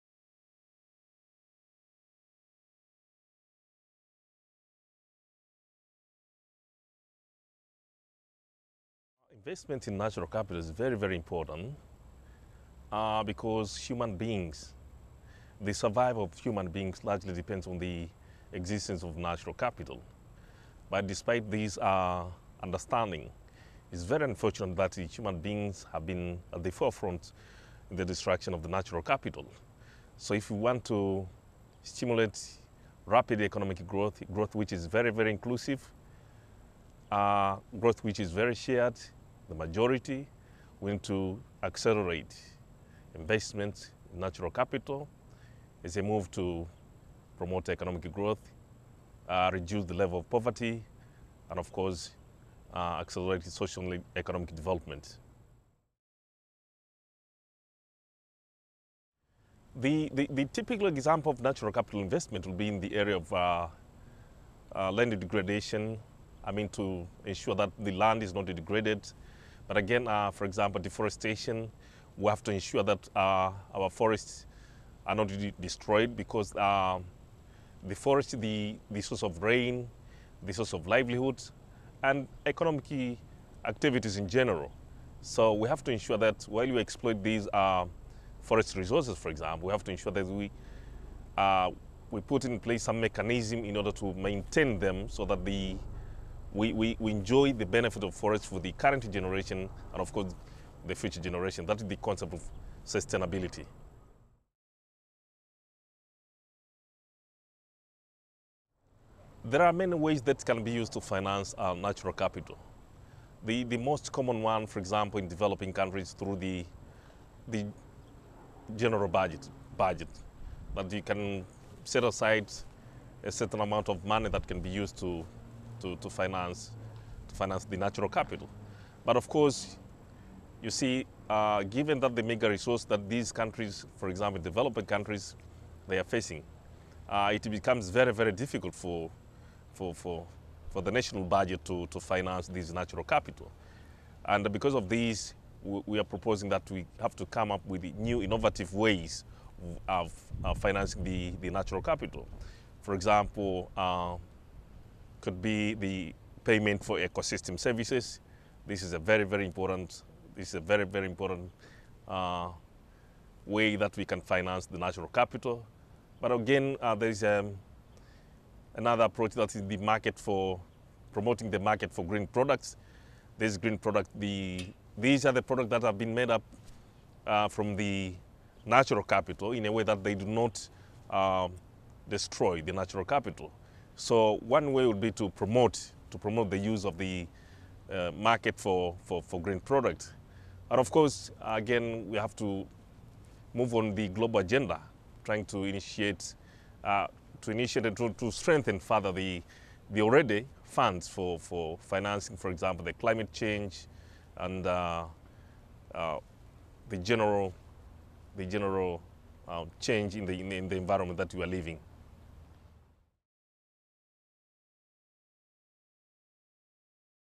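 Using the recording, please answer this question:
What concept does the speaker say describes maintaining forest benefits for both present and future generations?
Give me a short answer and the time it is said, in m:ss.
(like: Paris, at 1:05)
Sustainability, at 1:42.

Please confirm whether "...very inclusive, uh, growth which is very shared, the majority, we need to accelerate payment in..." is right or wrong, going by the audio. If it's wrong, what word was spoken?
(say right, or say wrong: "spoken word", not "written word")
wrong: "investment", not "payment".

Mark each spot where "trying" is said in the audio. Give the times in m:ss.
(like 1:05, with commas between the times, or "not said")
3:15.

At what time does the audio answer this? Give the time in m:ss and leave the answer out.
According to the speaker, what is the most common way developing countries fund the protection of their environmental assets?
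1:58.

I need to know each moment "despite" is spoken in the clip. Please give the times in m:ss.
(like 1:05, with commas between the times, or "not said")
0:21.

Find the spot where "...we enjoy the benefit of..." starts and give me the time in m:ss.
1:36.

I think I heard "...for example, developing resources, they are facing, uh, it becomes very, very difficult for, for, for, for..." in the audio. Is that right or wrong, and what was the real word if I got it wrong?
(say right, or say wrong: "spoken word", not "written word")
wrong: "countries", not "resources".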